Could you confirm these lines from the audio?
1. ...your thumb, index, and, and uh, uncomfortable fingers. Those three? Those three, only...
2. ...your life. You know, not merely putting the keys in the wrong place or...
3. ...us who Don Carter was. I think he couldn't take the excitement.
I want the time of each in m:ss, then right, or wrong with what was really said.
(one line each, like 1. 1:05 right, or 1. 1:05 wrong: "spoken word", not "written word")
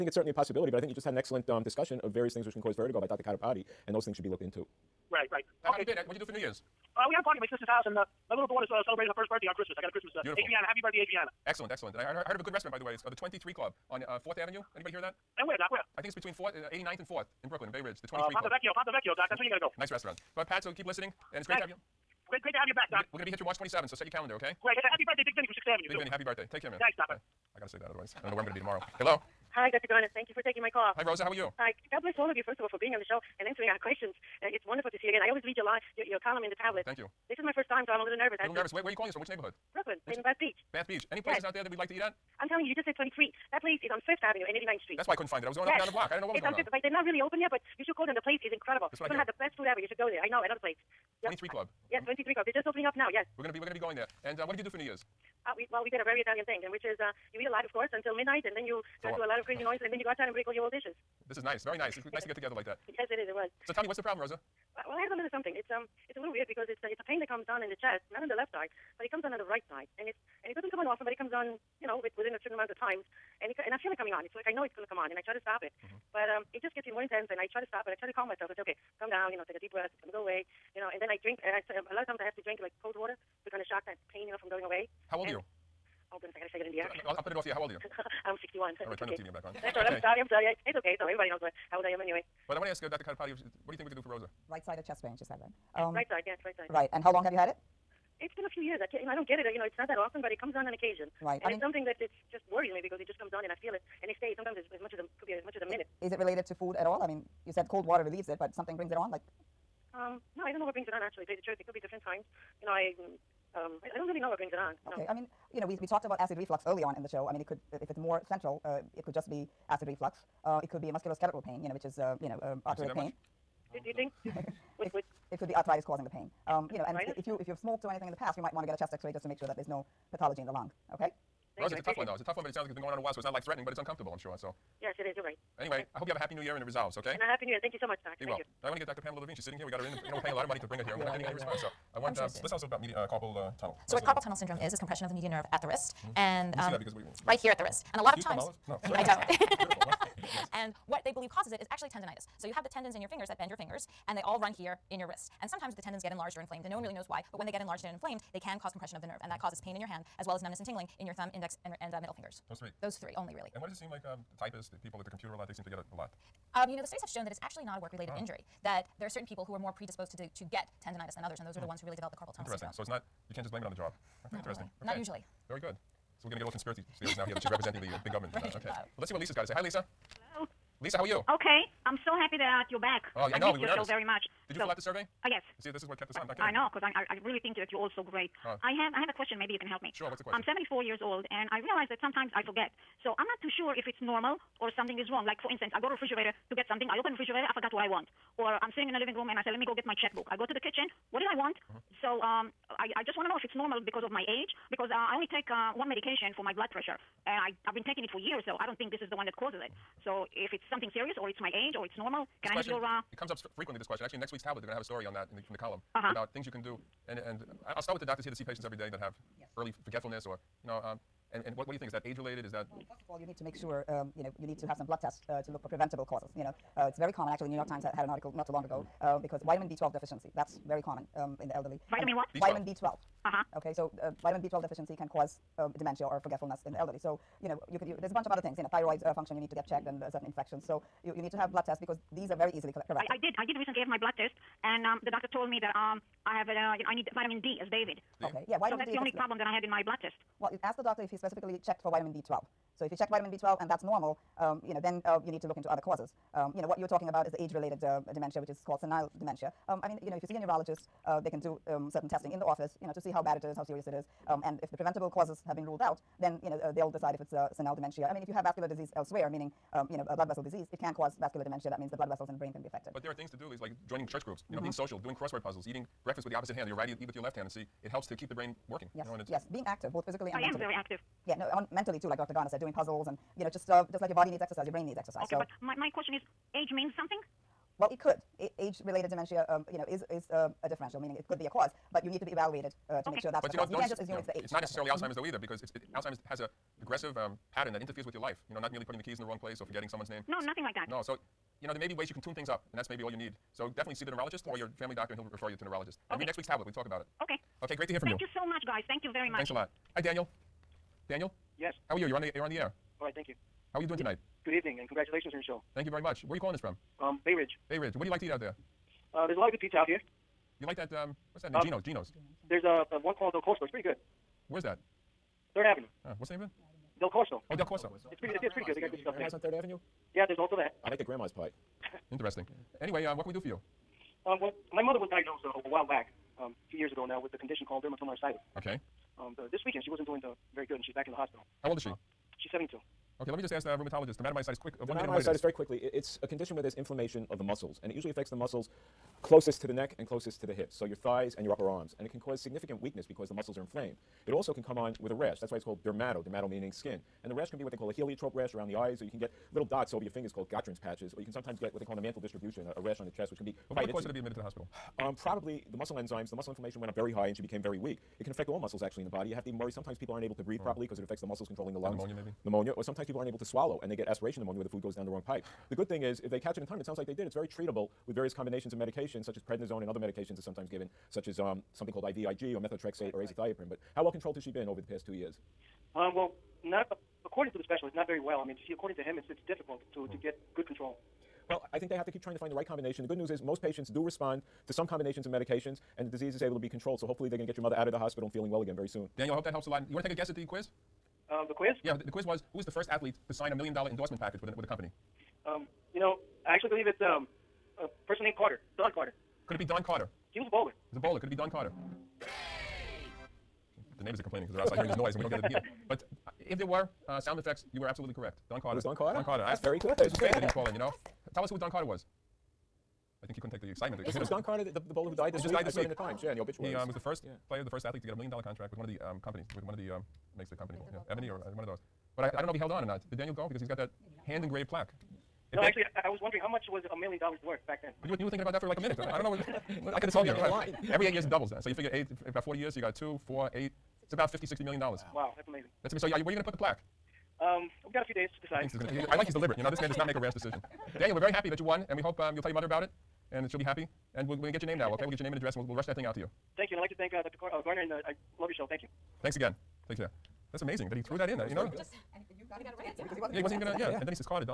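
1. 2:41 wrong: "middle", not "uncomfortable"
2. 4:58 right
3. 7:01 right.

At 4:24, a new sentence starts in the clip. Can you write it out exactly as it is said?
Um, and if the preventable causes have been ruled out, then, you know, uh, they'll decide if it's uh, senile dementia.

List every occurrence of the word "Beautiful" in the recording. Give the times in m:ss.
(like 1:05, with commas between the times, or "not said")
0:10, 2:29.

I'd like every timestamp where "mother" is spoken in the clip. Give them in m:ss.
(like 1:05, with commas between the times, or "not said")
5:34, 6:37, 7:32.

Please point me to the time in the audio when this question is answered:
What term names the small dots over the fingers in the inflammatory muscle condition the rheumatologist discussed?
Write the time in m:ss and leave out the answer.
6:00.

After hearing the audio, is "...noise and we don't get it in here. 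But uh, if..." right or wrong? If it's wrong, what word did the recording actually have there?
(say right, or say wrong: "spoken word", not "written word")
right.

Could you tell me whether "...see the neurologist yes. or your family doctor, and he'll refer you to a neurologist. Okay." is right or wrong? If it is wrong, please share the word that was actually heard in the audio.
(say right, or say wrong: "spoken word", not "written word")
right.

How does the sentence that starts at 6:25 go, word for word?
Um, well, not a, according to the specialist, not very well.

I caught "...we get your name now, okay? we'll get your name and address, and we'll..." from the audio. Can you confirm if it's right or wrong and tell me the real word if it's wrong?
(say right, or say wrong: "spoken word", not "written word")
right.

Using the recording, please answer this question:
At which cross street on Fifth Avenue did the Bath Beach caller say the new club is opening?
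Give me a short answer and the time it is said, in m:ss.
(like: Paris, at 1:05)
89th Street, at 0:44.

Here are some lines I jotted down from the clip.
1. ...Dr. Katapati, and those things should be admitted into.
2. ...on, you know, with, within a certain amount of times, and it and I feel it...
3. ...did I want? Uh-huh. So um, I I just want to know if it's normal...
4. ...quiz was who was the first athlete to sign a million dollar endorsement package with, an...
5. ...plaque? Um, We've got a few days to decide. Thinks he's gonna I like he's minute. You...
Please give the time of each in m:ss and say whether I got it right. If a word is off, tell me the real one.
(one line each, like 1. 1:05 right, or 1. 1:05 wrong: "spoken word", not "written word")
1. 0:03 wrong: "looked", not "admitted"
2. 1:11 right
3. 3:21 right
4. 6:42 right
5. 7:26 wrong: "deliberate", not "minute".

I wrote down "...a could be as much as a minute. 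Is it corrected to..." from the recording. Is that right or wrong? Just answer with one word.
wrong.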